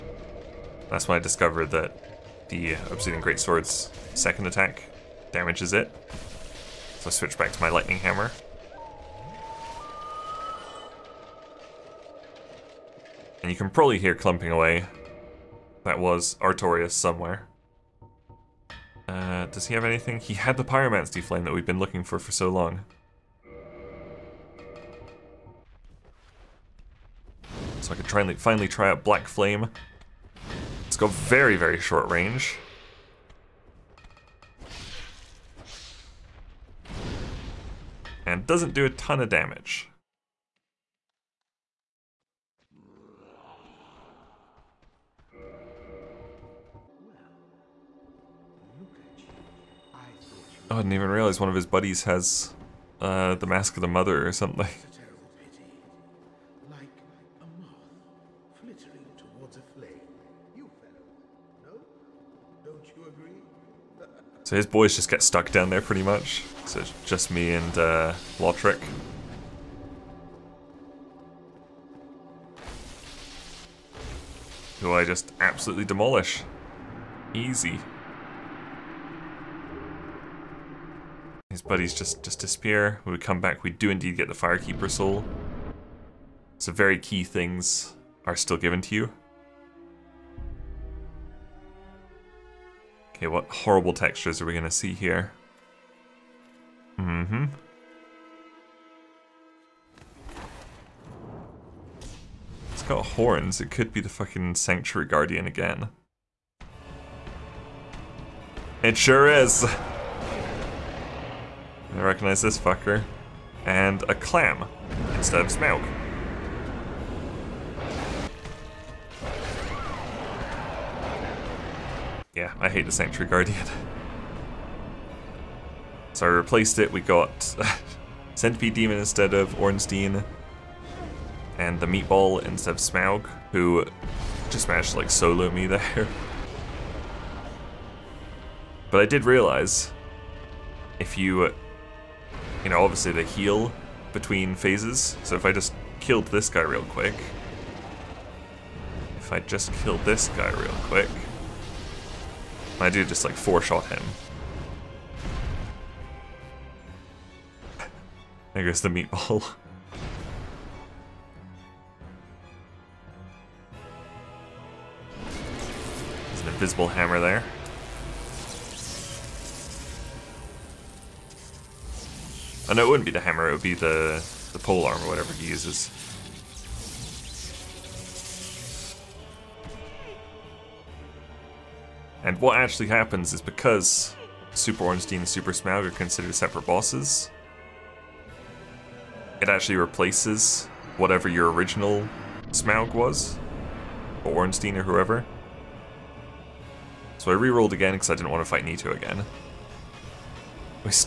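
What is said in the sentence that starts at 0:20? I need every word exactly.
He had the Pyromancy Flame that we've been looking for for so long.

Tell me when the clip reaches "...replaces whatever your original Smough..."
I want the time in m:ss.
3:09.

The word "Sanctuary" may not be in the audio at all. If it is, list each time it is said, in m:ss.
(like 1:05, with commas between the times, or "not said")
1:44, 2:02.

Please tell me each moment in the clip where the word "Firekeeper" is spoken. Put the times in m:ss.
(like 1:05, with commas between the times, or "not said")
1:24.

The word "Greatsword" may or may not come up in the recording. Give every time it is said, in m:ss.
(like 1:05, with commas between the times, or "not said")
0:03.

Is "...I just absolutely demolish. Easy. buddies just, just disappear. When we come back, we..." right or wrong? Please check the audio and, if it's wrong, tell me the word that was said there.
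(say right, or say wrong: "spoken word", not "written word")
right.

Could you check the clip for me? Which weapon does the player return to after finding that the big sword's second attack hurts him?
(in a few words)
Lightning Hammer.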